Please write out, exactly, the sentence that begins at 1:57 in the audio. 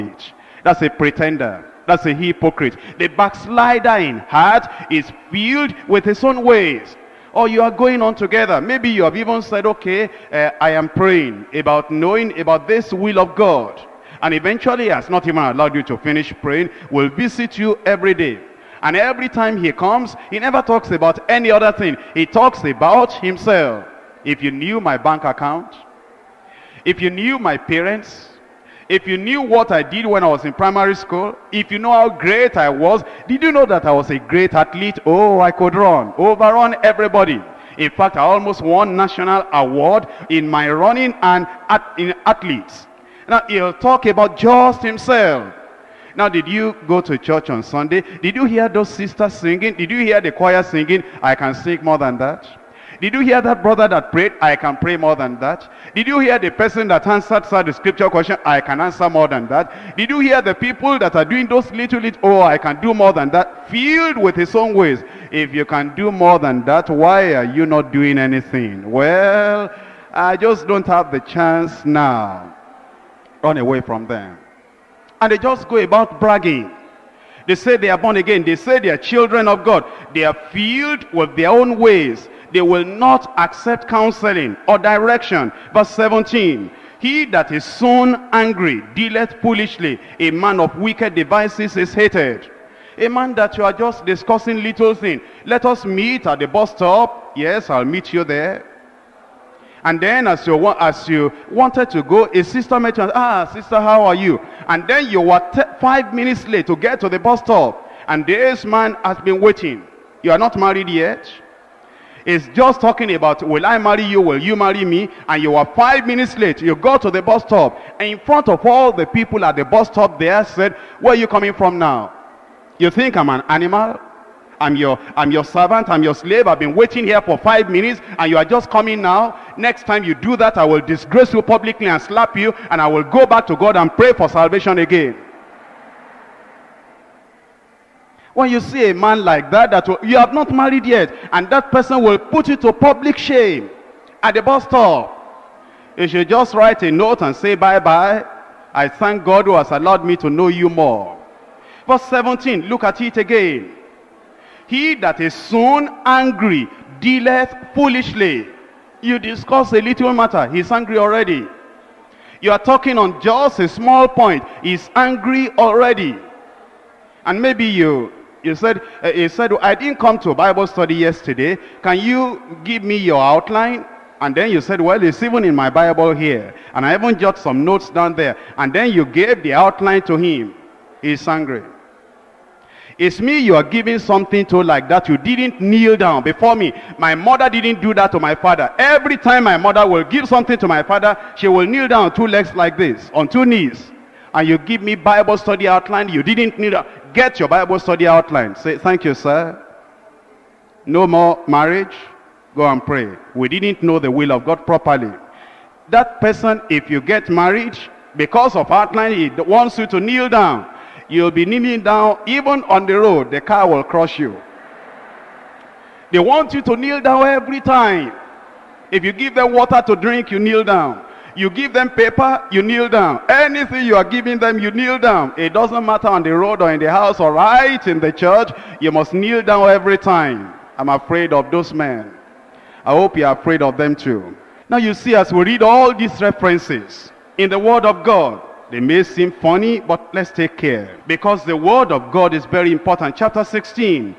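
And in front of all the people at the bus stop there said, where are you coming from now?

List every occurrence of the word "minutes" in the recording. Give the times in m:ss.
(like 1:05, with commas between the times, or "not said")
1:46, 1:56, 2:07.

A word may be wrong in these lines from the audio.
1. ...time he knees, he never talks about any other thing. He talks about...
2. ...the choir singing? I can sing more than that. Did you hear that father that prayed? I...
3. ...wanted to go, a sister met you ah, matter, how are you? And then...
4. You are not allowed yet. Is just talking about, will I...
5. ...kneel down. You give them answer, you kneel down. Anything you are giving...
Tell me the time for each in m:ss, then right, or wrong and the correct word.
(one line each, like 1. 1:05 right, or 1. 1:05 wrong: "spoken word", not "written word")
1. 0:19 wrong: "comes", not "knees"
2. 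0:50 wrong: "brother", not "father"
3. 1:41 wrong: "sister", not "matter"
4. 1:50 wrong: "married", not "allowed"
5. 3:40 wrong: "paper", not "answer".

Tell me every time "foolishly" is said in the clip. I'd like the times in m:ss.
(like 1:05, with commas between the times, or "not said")
1:29, 2:37.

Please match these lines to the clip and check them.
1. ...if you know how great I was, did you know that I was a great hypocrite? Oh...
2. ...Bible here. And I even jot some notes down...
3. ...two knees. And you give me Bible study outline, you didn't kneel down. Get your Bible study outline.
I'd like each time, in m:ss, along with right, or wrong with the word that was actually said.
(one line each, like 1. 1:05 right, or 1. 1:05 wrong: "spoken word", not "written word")
1. 0:31 wrong: "athlete", not "hypocrite"
2. 2:55 right
3. 3:13 right.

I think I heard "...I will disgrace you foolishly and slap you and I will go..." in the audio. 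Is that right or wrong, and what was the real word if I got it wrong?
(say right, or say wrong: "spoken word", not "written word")
wrong: "publicly", not "foolishly".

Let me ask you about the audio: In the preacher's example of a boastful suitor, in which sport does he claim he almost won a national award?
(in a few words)
running.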